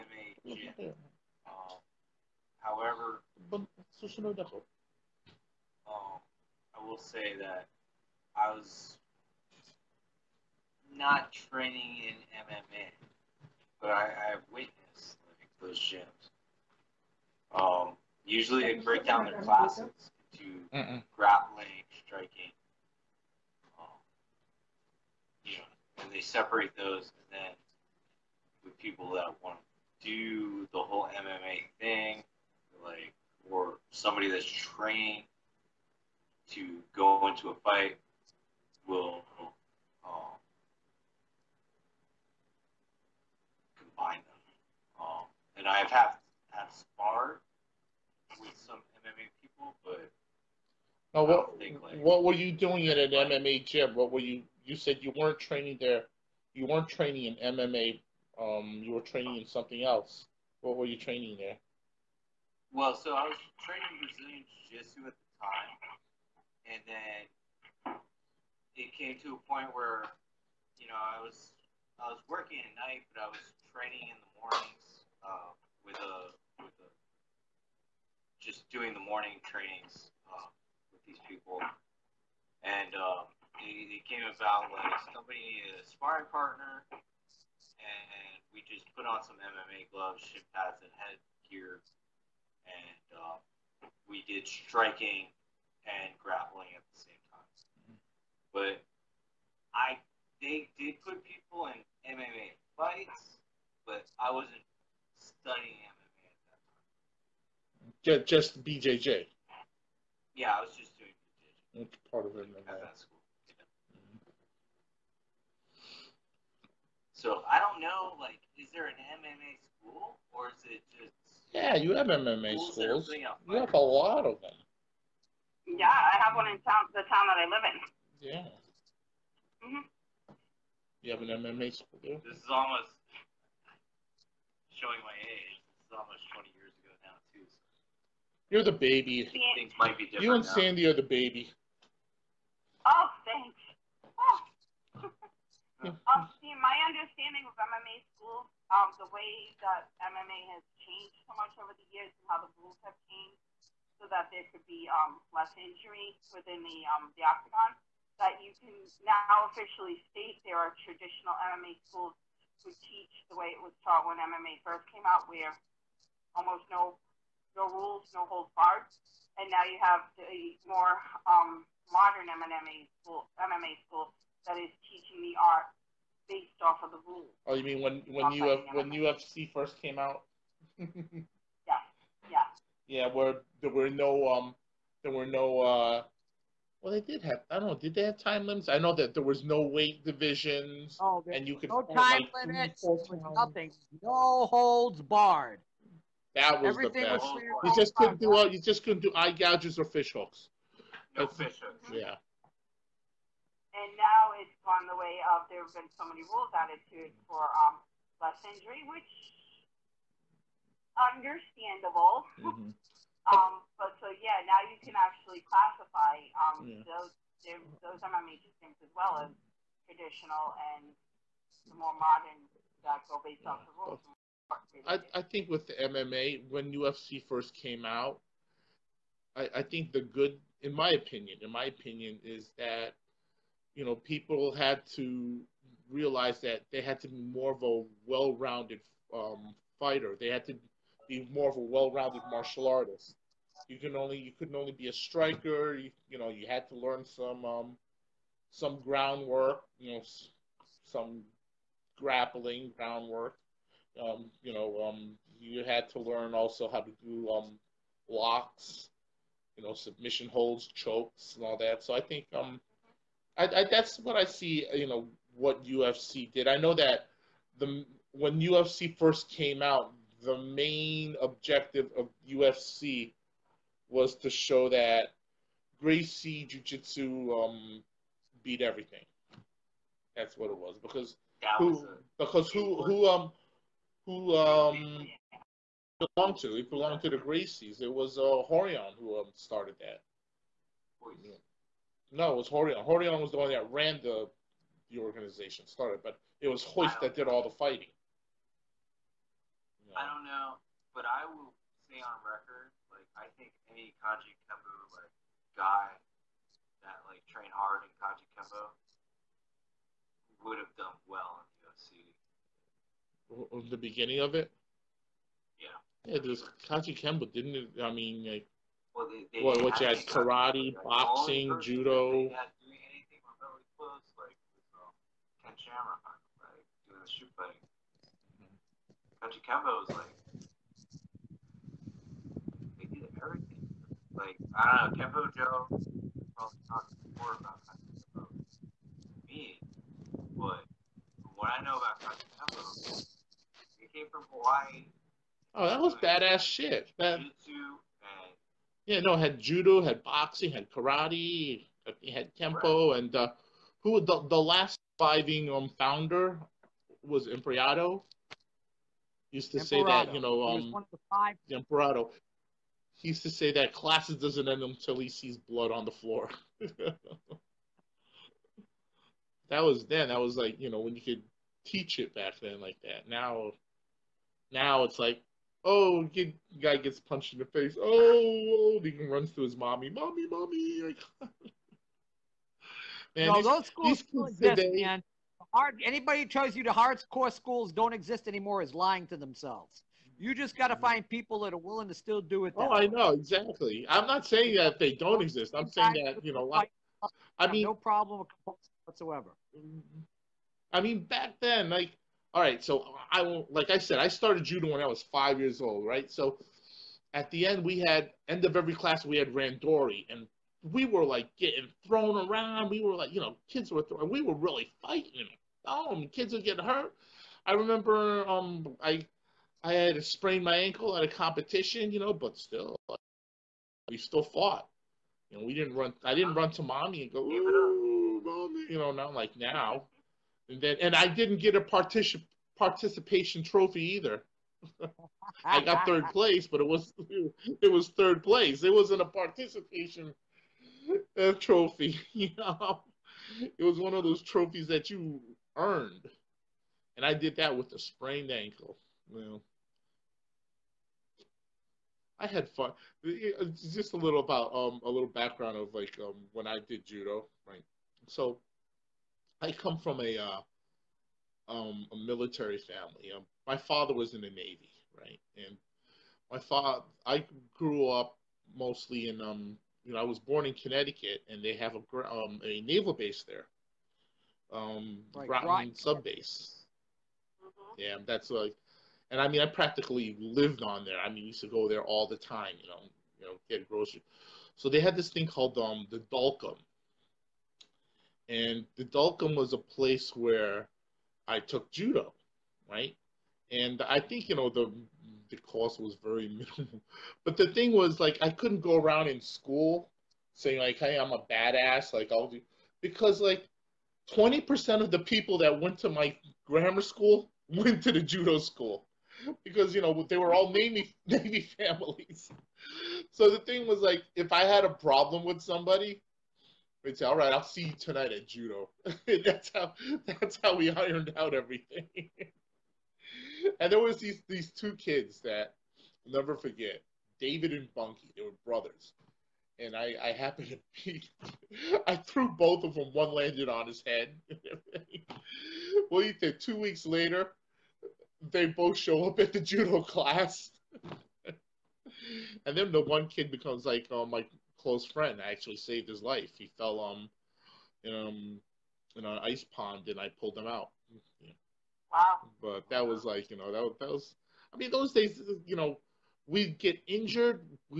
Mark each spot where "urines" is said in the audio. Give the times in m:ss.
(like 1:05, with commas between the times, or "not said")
not said.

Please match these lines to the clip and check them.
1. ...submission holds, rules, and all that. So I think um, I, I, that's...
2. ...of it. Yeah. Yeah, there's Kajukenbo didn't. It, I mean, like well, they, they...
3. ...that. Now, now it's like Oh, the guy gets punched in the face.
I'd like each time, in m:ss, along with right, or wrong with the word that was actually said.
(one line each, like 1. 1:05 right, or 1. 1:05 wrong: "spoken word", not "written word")
1. 4:19 wrong: "chokes", not "rules"
2. 5:14 right
3. 6:12 right.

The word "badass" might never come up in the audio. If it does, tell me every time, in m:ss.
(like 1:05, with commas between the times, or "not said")
5:45, 8:21.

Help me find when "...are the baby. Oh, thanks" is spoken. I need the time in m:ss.
2:20.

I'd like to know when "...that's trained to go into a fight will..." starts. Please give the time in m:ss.
0:34.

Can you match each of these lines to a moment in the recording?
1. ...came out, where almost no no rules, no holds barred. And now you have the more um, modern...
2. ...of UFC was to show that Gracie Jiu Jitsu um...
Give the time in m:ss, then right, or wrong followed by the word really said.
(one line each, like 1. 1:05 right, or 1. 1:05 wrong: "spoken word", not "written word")
1. 2:44 right
2. 4:31 right.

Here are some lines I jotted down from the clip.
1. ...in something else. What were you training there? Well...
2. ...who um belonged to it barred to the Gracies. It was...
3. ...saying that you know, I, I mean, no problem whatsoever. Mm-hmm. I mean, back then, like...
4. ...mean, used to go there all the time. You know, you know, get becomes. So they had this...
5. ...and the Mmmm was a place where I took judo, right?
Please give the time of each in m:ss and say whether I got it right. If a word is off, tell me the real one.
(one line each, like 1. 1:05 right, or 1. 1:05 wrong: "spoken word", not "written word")
1. 0:59 right
2. 4:44 wrong: "belonged", not "barred"
3. 6:35 right
4. 8:01 wrong: "groceries", not "becomes"
5. 8:08 wrong: "Dalcom", not "Mmmm".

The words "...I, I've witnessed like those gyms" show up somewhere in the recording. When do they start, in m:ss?
0:13.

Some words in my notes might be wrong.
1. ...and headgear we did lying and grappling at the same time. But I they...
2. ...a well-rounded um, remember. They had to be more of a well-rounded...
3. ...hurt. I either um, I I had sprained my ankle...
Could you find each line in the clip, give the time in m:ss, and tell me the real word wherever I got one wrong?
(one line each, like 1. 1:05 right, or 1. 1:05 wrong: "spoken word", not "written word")
1. 1:30 wrong: "striking", not "lying"
2. 3:57 wrong: "fighter", not "remember"
3. 6:56 wrong: "remember", not "either".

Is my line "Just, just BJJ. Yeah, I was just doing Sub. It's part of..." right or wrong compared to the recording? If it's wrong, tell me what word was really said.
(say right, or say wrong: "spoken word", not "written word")
wrong: "BJJ", not "Sub".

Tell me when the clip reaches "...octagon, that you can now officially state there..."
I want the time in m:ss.
2:37.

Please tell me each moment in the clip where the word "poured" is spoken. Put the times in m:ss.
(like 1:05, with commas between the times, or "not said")
not said.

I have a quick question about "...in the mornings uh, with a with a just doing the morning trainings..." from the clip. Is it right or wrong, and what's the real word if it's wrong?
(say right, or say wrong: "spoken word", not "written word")
right.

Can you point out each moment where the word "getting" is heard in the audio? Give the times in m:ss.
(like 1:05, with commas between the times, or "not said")
6:51.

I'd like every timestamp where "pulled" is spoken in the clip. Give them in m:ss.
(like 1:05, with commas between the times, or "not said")
9:10.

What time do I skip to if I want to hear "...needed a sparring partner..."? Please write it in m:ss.
1:25.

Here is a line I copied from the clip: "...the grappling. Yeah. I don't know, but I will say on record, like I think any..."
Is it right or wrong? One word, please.
wrong.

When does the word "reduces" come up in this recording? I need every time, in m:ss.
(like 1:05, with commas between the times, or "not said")
not said.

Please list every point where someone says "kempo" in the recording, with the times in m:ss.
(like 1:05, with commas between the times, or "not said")
5:35, 5:52.